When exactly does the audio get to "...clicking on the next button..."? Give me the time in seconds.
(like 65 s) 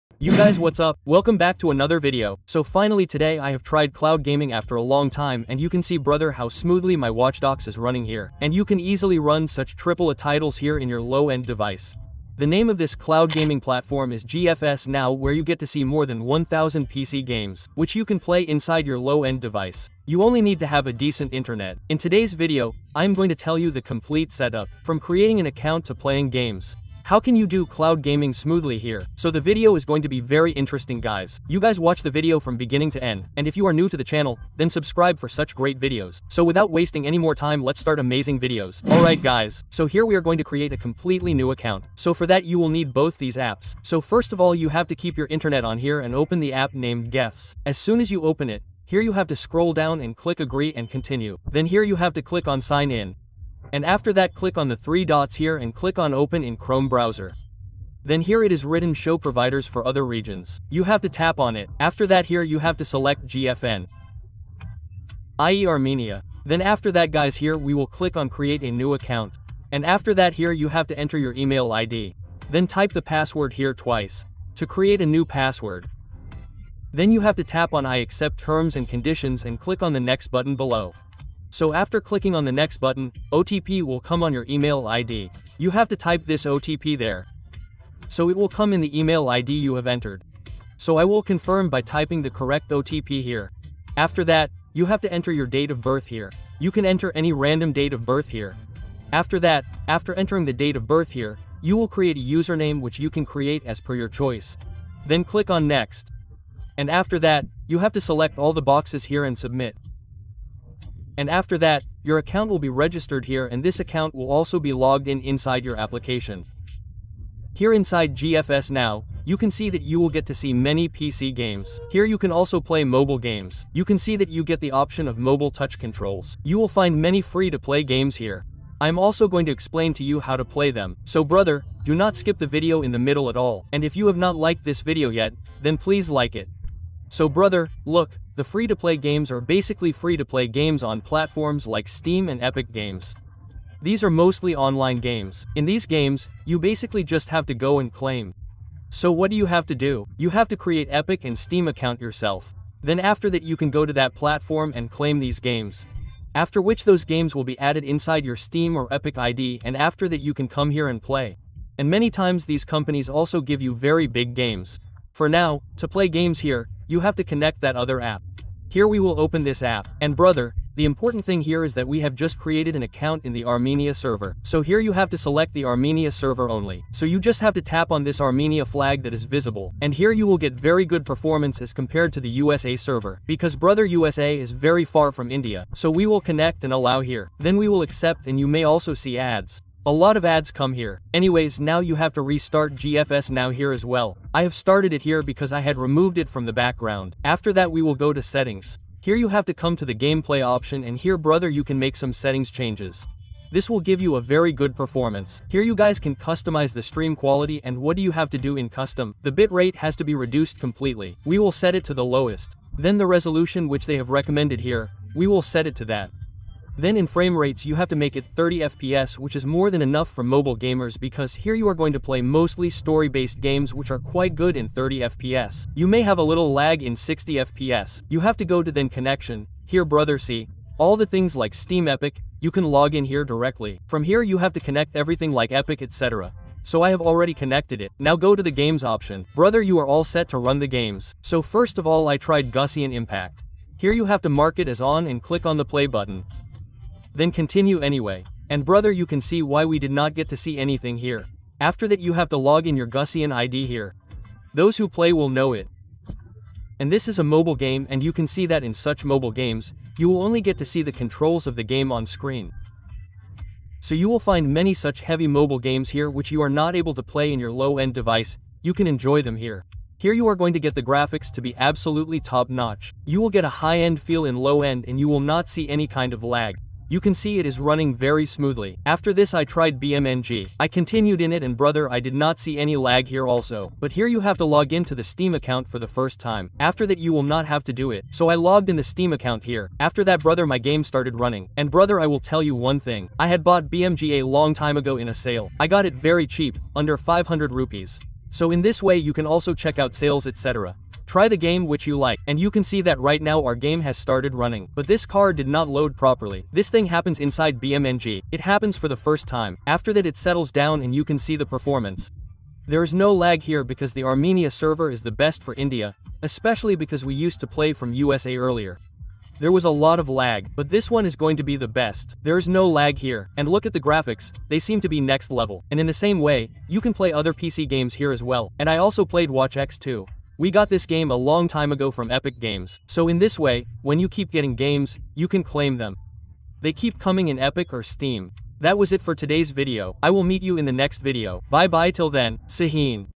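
81 s.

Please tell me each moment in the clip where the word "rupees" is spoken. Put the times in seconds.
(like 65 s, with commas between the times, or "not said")
297 s.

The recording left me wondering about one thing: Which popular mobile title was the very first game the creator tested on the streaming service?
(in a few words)
Genshin Impact.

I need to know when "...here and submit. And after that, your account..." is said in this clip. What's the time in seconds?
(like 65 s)
109 s.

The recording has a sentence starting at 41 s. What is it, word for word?
So for that you will need both these apps.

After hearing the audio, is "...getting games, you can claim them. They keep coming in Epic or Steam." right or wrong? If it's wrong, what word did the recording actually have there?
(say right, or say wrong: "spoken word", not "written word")
right.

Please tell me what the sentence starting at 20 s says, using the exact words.
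You only need to have a decent internet.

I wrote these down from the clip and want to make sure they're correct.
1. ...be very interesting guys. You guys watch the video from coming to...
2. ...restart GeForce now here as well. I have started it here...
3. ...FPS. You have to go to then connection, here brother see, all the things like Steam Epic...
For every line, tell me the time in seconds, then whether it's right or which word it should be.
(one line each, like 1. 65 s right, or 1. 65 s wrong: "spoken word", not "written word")
1. 30 s wrong: "beginning", not "coming"
2. 192 s right
3. 227 s right.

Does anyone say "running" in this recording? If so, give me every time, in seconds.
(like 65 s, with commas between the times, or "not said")
7 s, 277 s, 291 s, 304 s.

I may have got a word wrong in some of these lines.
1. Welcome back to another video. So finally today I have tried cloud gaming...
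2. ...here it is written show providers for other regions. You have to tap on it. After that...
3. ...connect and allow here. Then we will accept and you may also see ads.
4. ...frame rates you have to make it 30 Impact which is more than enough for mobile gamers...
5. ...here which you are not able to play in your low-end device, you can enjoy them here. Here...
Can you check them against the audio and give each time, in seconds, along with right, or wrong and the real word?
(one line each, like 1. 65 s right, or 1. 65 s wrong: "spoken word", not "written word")
1. 1 s right
2. 58 s right
3. 186 s right
4. 217 s wrong: "FPS", not "Impact"
5. 265 s right.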